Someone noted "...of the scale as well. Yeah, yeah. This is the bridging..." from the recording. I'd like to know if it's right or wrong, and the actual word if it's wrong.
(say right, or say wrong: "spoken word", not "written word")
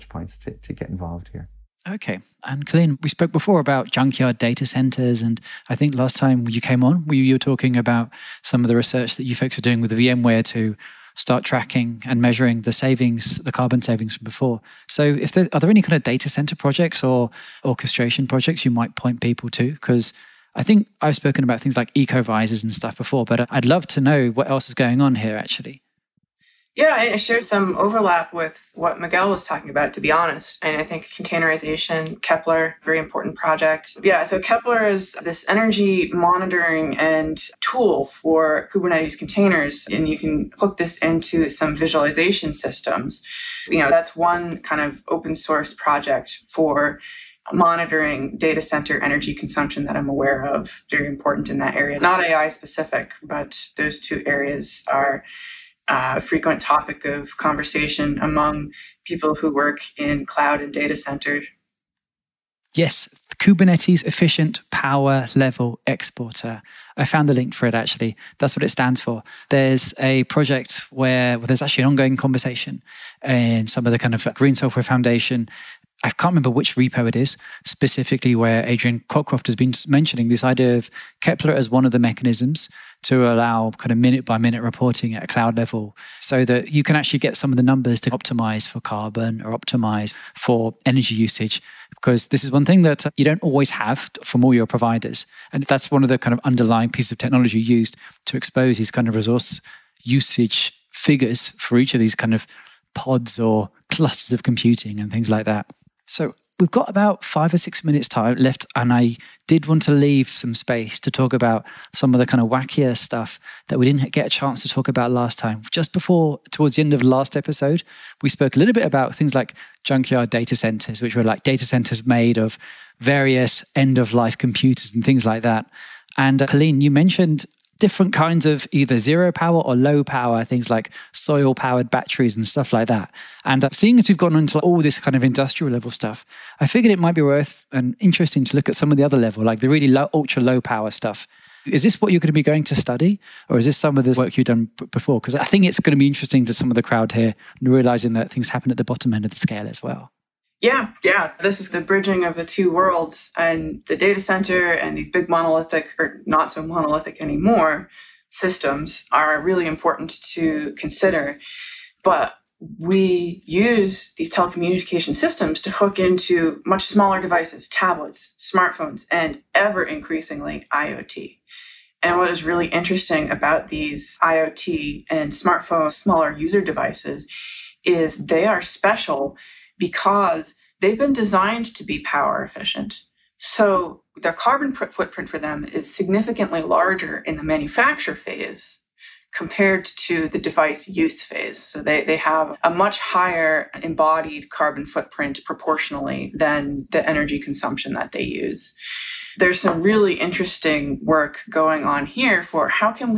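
right.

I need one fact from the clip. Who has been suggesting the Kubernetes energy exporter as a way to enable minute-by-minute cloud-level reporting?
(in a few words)
Adrian Cockcroft.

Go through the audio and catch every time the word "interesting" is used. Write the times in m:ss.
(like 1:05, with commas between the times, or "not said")
2:17, 2:26, 2:52, 3:20.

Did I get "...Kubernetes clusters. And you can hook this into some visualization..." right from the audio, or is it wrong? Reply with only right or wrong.
wrong.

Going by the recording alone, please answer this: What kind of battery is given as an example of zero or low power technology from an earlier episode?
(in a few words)
Soil powered batteries.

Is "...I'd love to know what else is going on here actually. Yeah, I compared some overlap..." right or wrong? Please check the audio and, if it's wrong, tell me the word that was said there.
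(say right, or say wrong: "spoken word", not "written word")
wrong: "shared", not "compared".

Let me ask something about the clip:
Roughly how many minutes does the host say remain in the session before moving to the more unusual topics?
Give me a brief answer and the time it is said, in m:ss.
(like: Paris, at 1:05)
5 or 6 minutes, at 1:47.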